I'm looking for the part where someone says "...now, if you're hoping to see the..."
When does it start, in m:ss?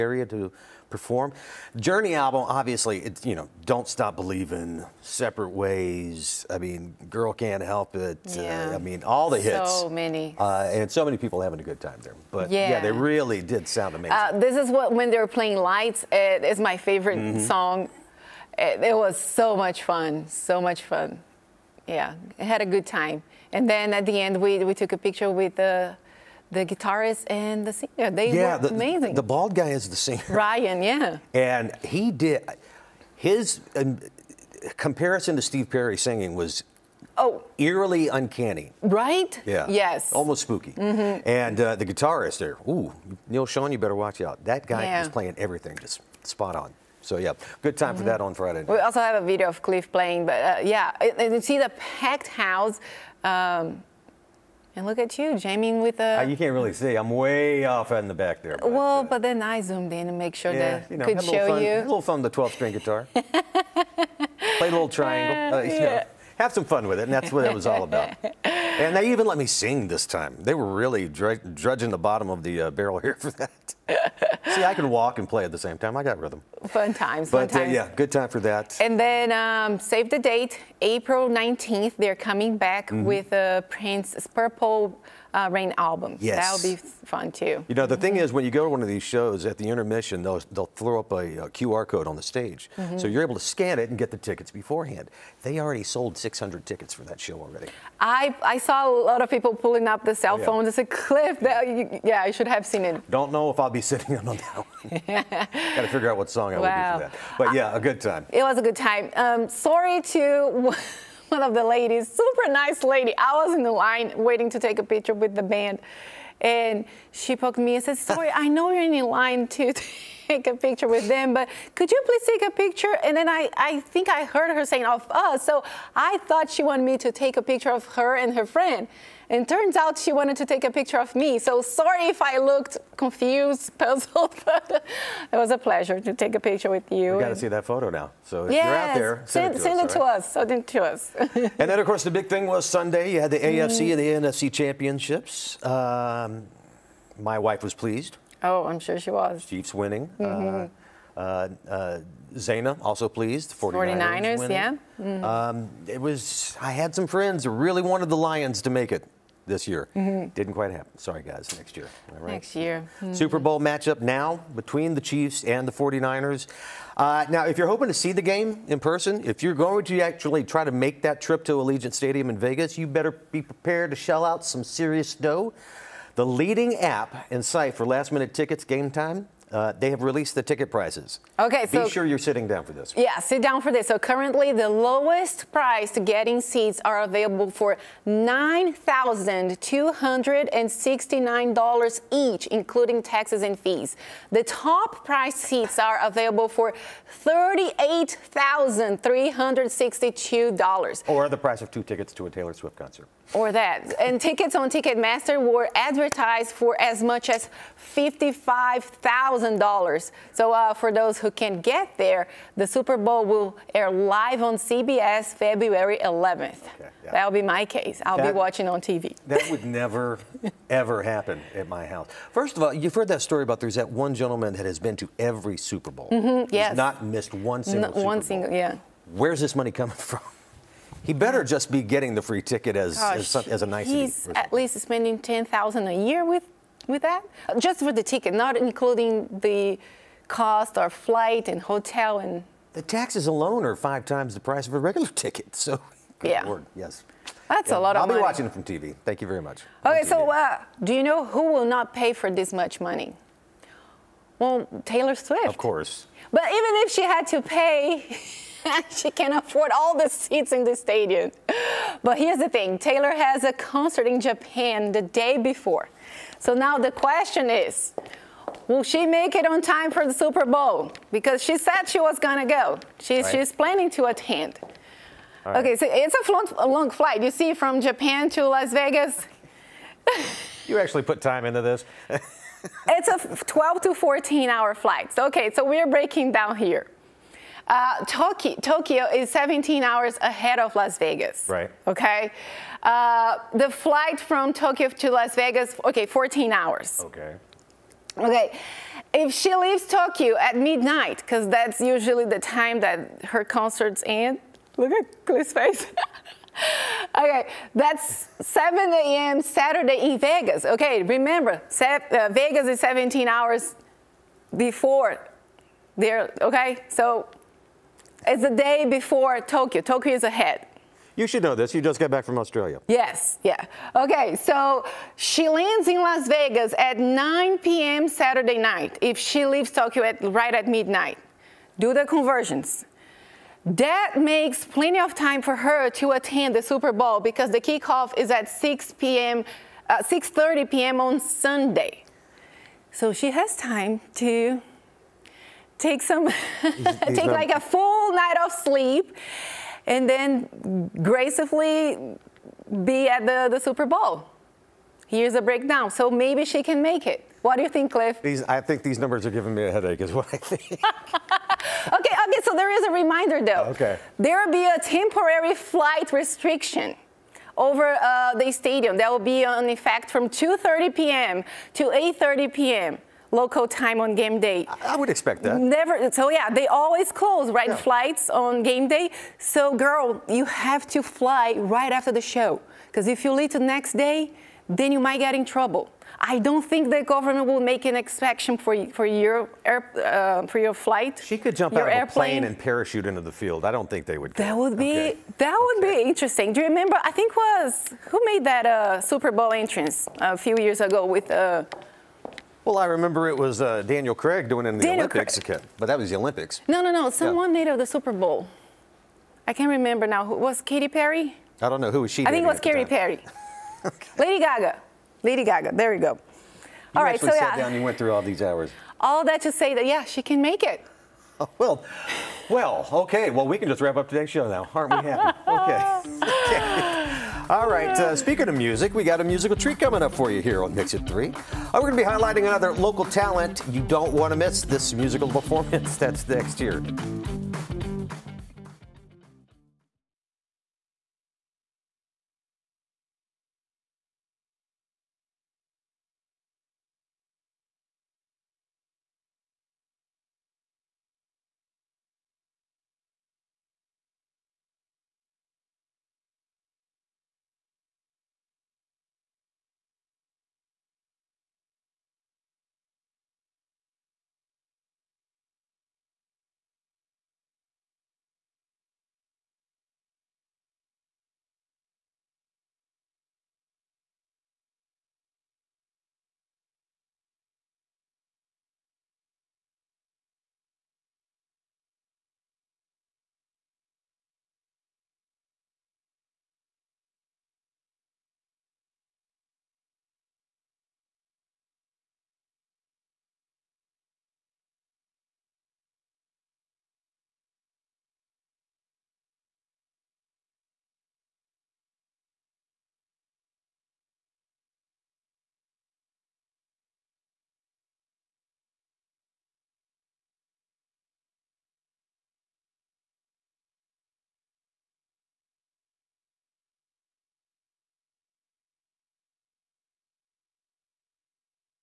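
2:47.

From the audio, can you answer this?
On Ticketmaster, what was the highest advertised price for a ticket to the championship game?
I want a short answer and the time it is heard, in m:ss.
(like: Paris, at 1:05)
$55,000, at 3:27.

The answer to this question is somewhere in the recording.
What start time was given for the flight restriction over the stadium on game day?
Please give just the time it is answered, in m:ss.
6:10.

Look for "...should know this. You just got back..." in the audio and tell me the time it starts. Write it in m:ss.
5:21.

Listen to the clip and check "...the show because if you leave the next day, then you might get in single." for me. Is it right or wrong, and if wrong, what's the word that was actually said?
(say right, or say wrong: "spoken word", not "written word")
wrong: "trouble", not "single".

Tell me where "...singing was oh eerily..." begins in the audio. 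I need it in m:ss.
0:35.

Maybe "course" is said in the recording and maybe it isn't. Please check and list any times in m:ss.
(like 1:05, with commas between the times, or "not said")
2:21, 4:15.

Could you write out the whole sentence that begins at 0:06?
I mean, Girl Can't Help It.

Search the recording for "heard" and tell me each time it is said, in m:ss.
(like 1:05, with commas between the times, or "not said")
2:04, 3:42.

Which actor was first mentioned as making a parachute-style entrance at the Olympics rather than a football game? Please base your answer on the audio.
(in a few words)
Daniel Craig.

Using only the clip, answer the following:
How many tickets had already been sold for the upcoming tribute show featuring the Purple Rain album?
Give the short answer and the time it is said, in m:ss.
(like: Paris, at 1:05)
600, at 1:36.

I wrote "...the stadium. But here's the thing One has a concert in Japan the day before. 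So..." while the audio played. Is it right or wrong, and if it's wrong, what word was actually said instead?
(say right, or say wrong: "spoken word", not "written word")
wrong: "Taylor", not "One".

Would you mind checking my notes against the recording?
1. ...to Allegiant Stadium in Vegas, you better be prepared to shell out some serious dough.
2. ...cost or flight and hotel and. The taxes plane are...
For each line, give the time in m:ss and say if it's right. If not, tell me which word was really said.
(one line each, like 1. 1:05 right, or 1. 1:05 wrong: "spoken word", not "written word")
1. 2:51 right
2. 4:00 wrong: "alone", not "plane".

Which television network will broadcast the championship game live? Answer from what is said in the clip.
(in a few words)
CBS.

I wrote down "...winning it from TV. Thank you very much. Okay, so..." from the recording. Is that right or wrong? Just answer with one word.
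wrong.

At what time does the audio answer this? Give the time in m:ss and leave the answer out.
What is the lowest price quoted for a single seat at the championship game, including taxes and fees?
3:08.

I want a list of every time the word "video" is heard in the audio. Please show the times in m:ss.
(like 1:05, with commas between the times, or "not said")
0:49.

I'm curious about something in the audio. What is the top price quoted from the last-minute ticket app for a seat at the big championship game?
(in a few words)
$38,362.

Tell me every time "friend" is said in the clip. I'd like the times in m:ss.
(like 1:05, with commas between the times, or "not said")
2:08, 2:37.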